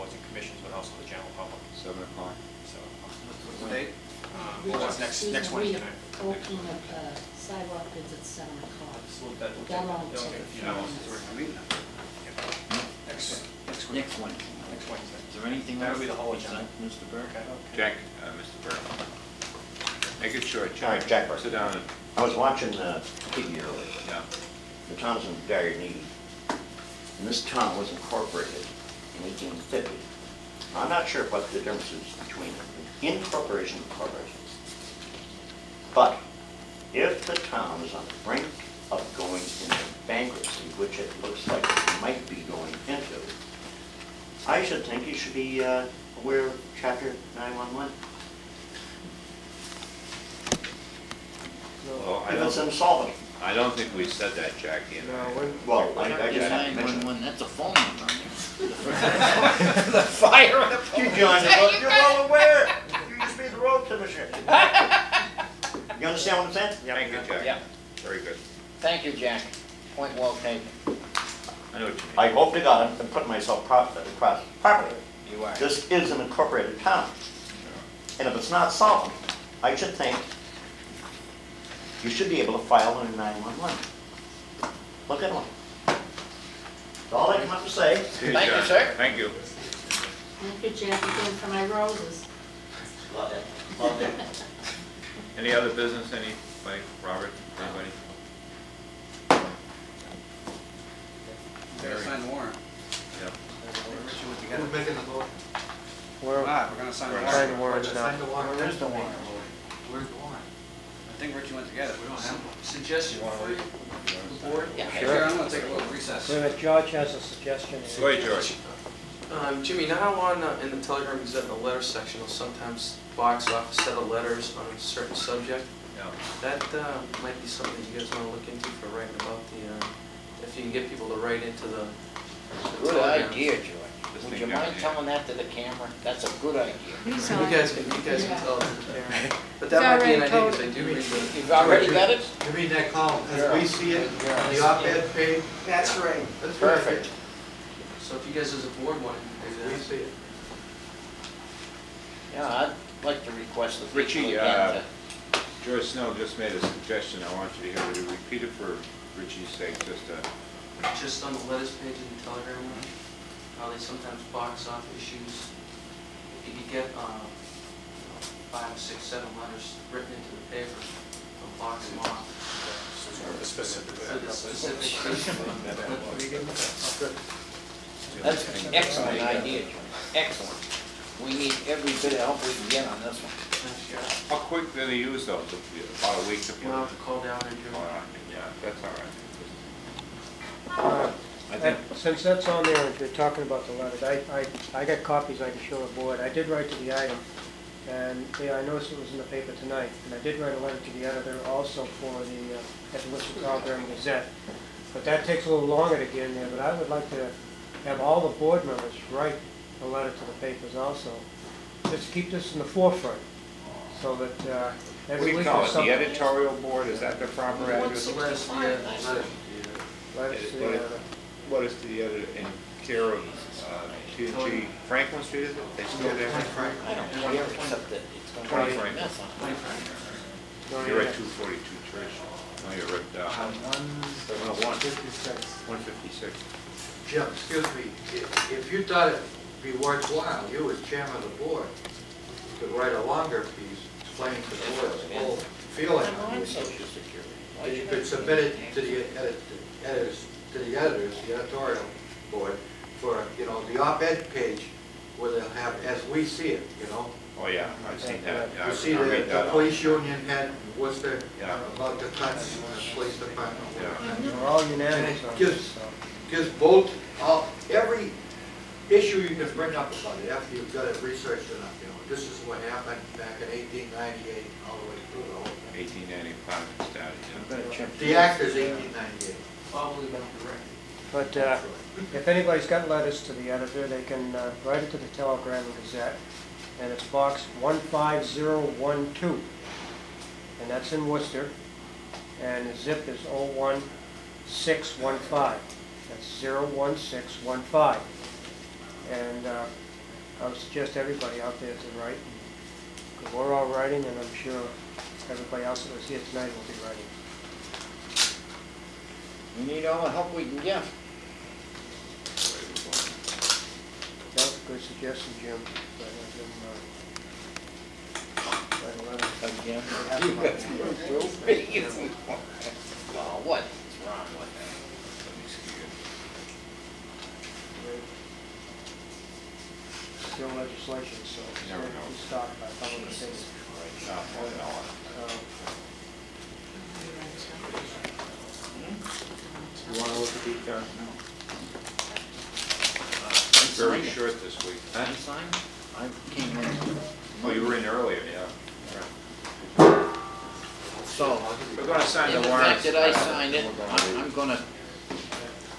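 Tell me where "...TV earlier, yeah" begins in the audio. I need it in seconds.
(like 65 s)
23 s.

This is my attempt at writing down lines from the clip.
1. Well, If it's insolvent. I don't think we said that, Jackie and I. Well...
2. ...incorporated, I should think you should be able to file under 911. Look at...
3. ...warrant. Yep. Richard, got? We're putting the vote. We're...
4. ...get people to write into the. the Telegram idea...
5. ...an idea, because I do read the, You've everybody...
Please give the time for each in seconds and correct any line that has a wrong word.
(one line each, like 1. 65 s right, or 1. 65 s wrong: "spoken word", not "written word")
1. 52 s right
2. 78 s wrong: "solved", not "incorporated"
3. 102 s wrong: "making", not "putting"
4. 130 s wrong: "Good", not "Telegram"
5. 140 s wrong: "already", not "everybody".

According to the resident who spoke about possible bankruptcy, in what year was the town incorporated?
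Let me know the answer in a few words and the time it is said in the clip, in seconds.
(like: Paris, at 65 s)
1850, at 29 s.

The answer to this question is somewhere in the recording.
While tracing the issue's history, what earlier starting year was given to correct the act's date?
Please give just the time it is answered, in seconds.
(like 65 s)
276 s.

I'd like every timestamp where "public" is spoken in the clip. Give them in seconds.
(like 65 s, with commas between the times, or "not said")
1 s, 332 s.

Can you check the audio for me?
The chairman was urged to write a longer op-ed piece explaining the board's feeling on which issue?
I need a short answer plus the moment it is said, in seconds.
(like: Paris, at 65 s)
Social Security, at 246 s.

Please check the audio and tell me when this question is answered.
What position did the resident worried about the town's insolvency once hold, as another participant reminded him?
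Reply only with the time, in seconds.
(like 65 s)
63 s.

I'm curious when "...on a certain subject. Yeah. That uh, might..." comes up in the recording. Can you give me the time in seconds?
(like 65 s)
124 s.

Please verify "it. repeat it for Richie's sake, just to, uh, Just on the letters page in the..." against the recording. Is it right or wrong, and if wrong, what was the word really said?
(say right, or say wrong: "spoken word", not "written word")
right.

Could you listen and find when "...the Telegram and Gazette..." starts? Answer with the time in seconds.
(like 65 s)
284 s.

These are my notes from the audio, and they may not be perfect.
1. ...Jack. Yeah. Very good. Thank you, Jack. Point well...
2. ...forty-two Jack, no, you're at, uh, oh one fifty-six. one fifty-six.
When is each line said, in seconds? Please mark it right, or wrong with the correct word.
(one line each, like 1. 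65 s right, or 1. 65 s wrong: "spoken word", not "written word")
1. 67 s right
2. 231 s wrong: "Church", not "Jack".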